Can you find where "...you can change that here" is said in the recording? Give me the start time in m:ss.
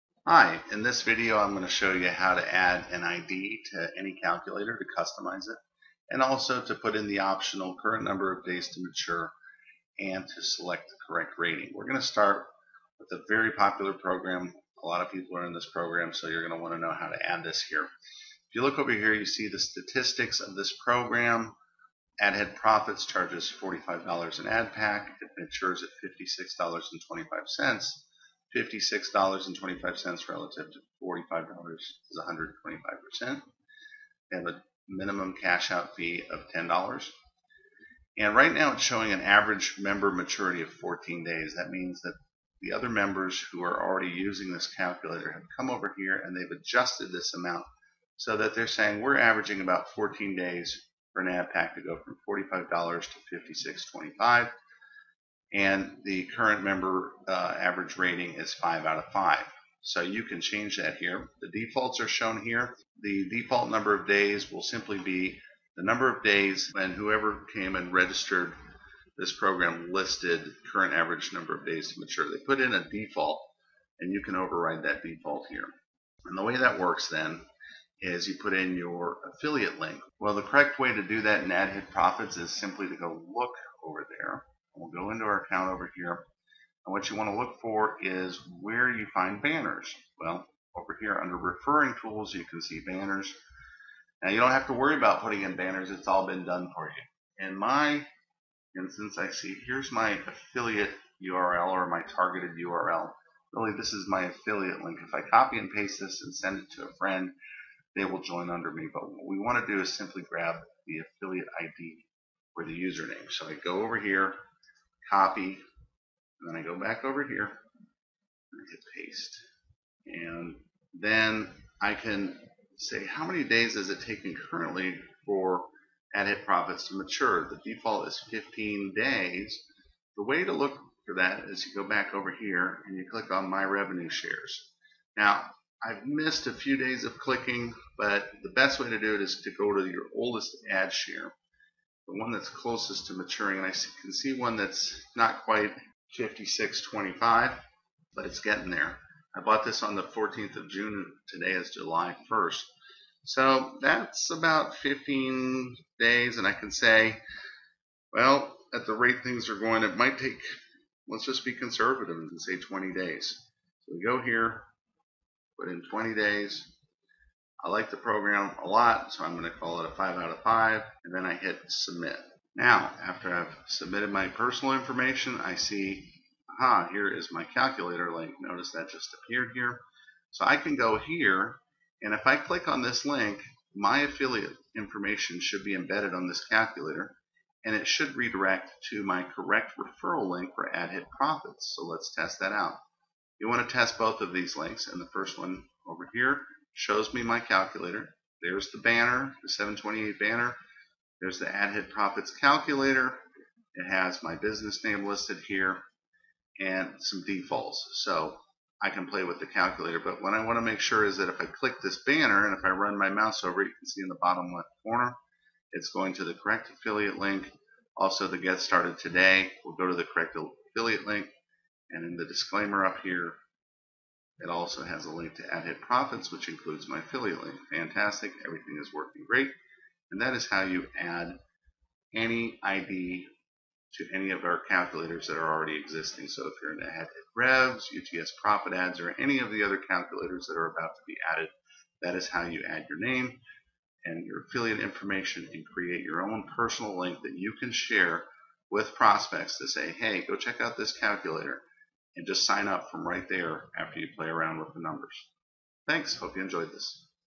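1:00.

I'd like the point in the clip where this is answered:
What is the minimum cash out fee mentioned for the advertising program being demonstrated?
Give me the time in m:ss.
0:36.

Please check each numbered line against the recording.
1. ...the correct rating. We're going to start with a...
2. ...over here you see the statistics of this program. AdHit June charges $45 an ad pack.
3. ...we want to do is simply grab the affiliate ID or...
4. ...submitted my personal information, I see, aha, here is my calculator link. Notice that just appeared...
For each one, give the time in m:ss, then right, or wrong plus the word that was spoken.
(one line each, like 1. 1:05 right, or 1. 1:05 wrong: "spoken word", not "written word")
1. 0:10 right
2. 0:18 wrong: "Profits", not "June"
3. 1:49 right
4. 2:53 right.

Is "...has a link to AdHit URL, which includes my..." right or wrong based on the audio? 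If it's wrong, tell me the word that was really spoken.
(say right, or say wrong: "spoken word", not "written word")
wrong: "Profits", not "URL".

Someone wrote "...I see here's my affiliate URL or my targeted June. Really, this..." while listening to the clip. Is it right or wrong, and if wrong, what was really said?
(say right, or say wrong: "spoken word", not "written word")
wrong: "URL", not "June".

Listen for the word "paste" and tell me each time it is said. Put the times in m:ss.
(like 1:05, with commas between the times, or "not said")
1:45, 1:58.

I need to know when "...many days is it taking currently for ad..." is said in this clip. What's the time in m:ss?
2:03.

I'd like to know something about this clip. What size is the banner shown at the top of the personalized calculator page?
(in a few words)
728.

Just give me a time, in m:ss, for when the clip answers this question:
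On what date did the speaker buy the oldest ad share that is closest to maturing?
2:30.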